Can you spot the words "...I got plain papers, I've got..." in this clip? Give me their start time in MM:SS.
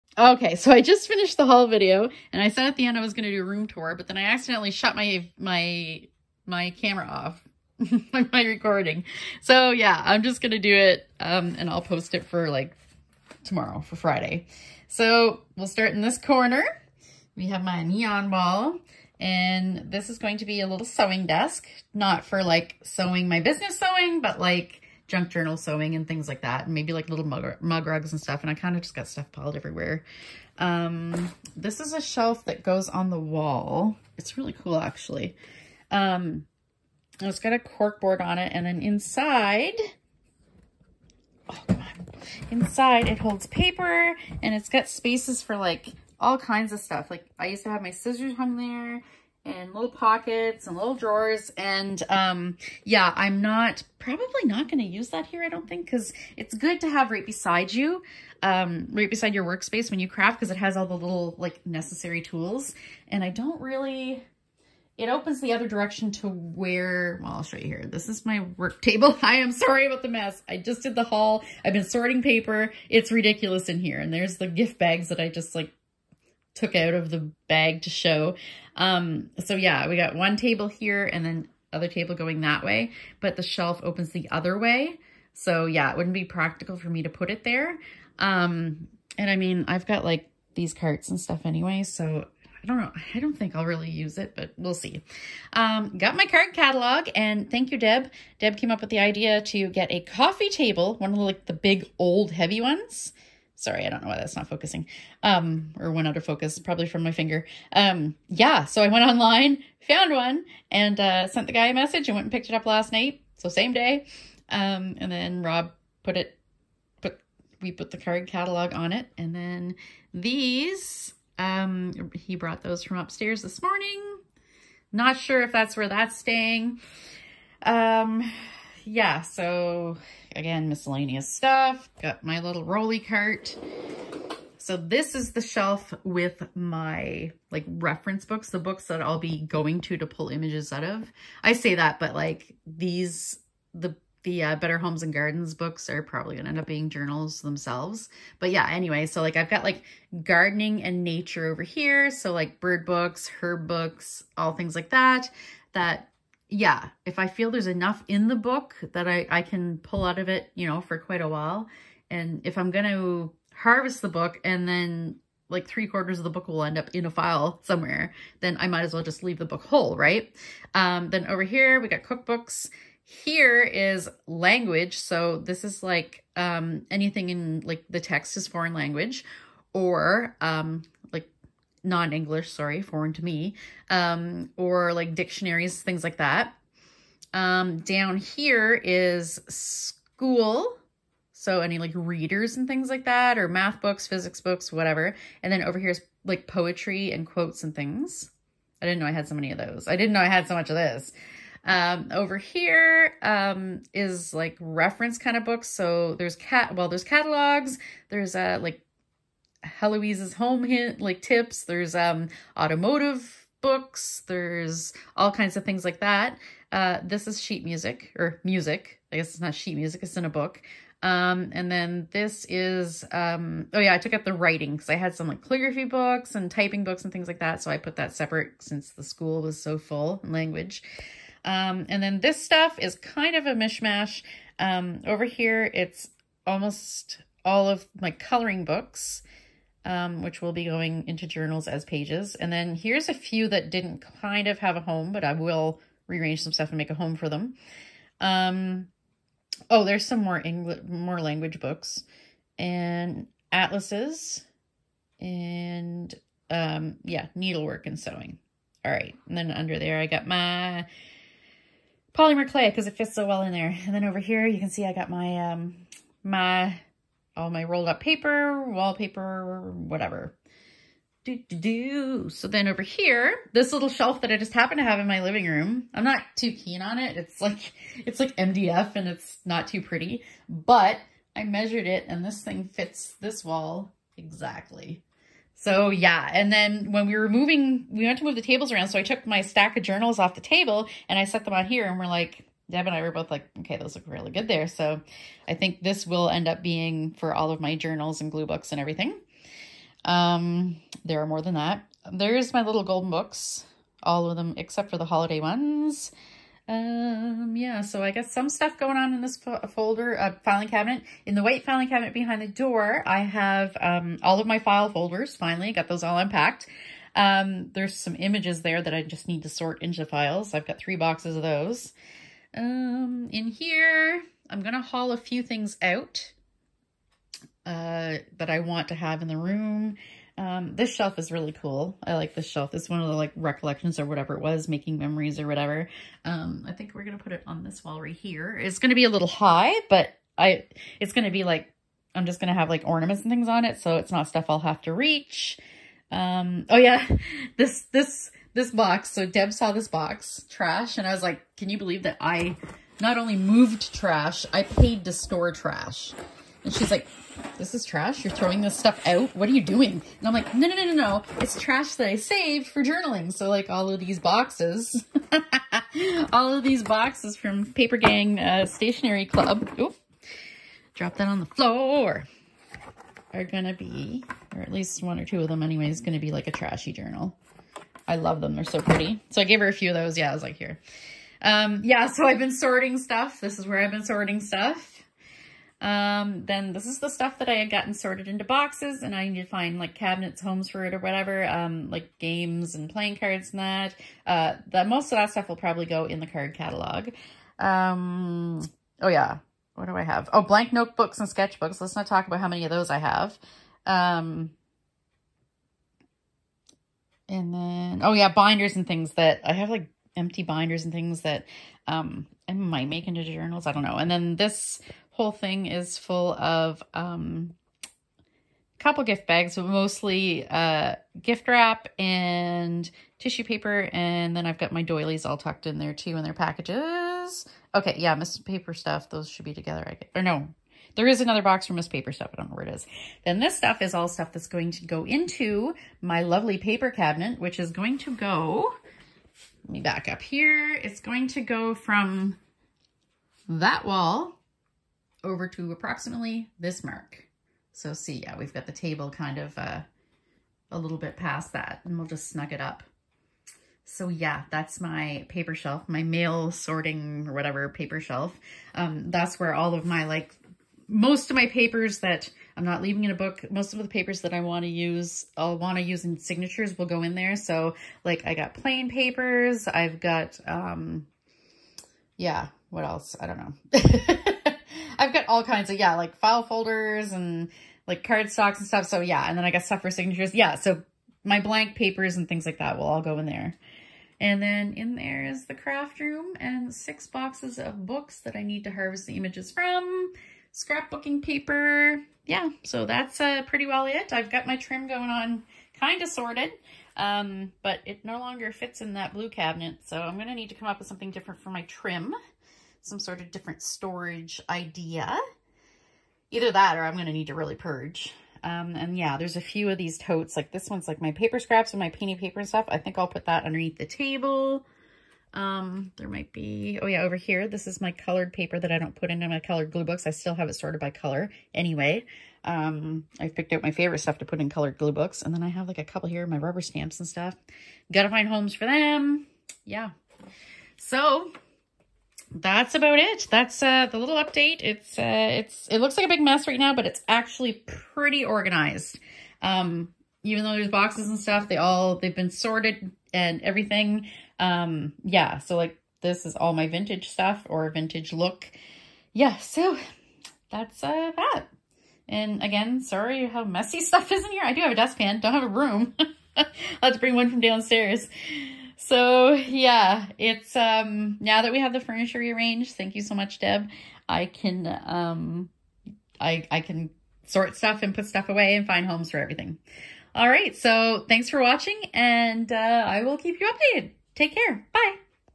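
07:48.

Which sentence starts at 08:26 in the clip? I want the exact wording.
Either that or I'm going to need to really purge.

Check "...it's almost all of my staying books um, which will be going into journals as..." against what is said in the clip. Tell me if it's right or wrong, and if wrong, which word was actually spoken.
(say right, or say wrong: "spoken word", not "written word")
wrong: "coloring", not "staying".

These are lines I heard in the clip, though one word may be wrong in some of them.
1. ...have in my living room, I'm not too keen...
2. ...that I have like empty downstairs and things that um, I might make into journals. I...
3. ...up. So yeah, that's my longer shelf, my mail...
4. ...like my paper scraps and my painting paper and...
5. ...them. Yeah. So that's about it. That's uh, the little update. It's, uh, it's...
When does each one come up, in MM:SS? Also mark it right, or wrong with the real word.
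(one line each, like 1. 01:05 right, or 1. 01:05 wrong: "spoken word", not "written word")
1. 04:34 right
2. 06:49 wrong: "binders", not "downstairs"
3. 07:32 wrong: "paper", not "longer"
4. 08:30 right
5. 08:48 right.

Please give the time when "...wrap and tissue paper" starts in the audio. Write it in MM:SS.
07:01.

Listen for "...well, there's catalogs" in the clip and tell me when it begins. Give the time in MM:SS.
03:26.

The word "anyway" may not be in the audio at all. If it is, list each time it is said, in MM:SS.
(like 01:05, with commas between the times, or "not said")
01:31, 02:28, 06:15, 08:41.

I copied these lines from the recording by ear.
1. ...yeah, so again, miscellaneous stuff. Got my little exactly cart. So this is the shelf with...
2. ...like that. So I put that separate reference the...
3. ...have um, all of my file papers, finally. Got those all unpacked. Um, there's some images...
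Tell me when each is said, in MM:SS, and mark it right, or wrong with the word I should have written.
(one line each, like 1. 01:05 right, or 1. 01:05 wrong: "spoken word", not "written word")
1. 02:08 wrong: "rolly", not "exactly"
2. 03:47 wrong: "since", not "reference"
3. 05:13 wrong: "folders", not "papers".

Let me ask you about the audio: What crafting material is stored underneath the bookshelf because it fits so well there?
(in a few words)
polymer clay.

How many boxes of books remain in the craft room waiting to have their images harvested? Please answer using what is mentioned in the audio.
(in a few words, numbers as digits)
6.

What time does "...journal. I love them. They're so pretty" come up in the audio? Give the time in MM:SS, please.
06:16.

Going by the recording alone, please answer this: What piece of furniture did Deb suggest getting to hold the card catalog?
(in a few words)
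coffee table.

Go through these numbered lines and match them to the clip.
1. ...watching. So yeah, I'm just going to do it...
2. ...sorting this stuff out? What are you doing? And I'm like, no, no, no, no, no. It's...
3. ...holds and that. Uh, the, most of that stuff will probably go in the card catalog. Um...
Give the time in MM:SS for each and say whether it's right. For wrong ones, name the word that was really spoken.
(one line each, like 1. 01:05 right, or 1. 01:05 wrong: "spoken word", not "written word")
1. 00:08 wrong: "recording", not "watching"
2. 05:58 wrong: "throwing", not "sorting"
3. 06:33 wrong: "cards", not "holds".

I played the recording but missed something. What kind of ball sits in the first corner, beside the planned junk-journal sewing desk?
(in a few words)
neon ball.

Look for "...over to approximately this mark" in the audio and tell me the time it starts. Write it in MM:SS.
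07:25.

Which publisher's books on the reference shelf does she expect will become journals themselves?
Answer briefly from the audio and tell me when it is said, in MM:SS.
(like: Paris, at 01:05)
Better Homes and Gardens, at 02:24.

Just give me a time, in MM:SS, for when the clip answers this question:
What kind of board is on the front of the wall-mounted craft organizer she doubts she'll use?
00:37.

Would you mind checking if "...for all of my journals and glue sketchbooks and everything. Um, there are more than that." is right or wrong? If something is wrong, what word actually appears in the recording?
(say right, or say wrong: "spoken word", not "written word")
wrong: "books", not "sketchbooks".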